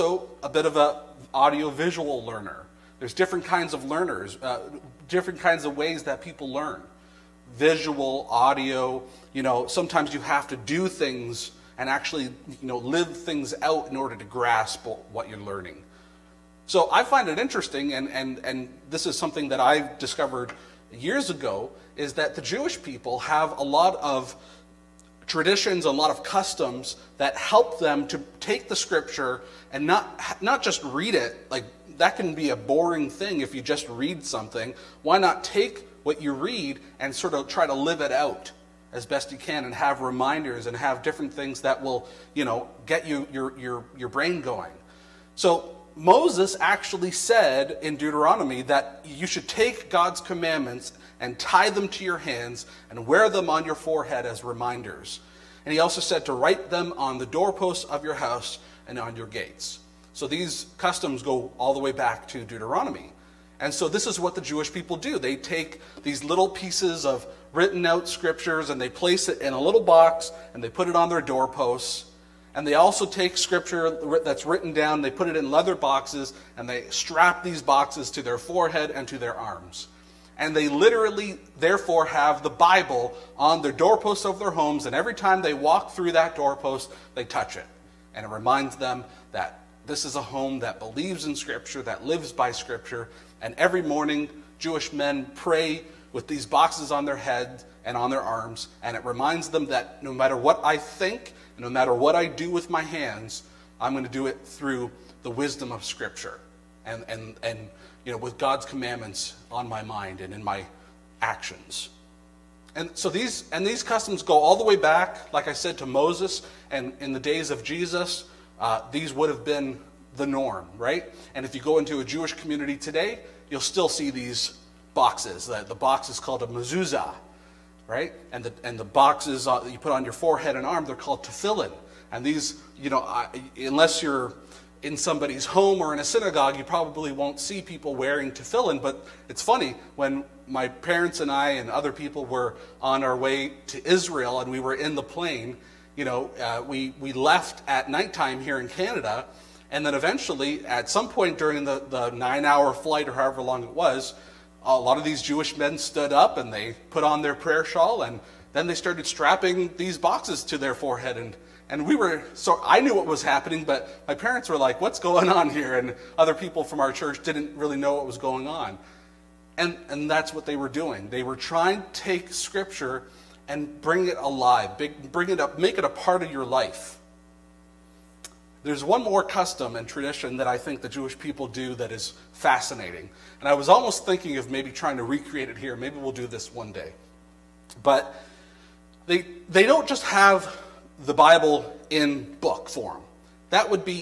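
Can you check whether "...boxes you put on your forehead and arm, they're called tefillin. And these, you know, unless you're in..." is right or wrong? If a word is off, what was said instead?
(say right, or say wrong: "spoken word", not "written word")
right.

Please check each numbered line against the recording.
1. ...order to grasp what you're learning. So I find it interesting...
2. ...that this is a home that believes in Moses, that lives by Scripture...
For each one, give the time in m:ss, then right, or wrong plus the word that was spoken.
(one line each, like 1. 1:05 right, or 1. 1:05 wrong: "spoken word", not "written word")
1. 0:13 right
2. 1:29 wrong: "Scripture", not "Moses".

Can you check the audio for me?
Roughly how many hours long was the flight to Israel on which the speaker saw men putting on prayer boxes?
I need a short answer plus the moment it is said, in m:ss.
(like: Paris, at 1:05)
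9, at 2:32.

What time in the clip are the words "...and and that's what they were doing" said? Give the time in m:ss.
2:49.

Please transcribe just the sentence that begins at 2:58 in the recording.
There's one more custom and tradition that I think the Jewish people do that is fascinating.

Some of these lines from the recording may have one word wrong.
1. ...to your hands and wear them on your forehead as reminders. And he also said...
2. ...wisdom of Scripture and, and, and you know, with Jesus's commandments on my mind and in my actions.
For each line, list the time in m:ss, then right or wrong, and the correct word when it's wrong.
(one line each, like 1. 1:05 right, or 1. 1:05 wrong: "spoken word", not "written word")
1. 0:51 right
2. 1:45 wrong: "God", not "Jesus".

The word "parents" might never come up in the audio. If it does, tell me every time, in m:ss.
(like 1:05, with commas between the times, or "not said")
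2:20, 2:44.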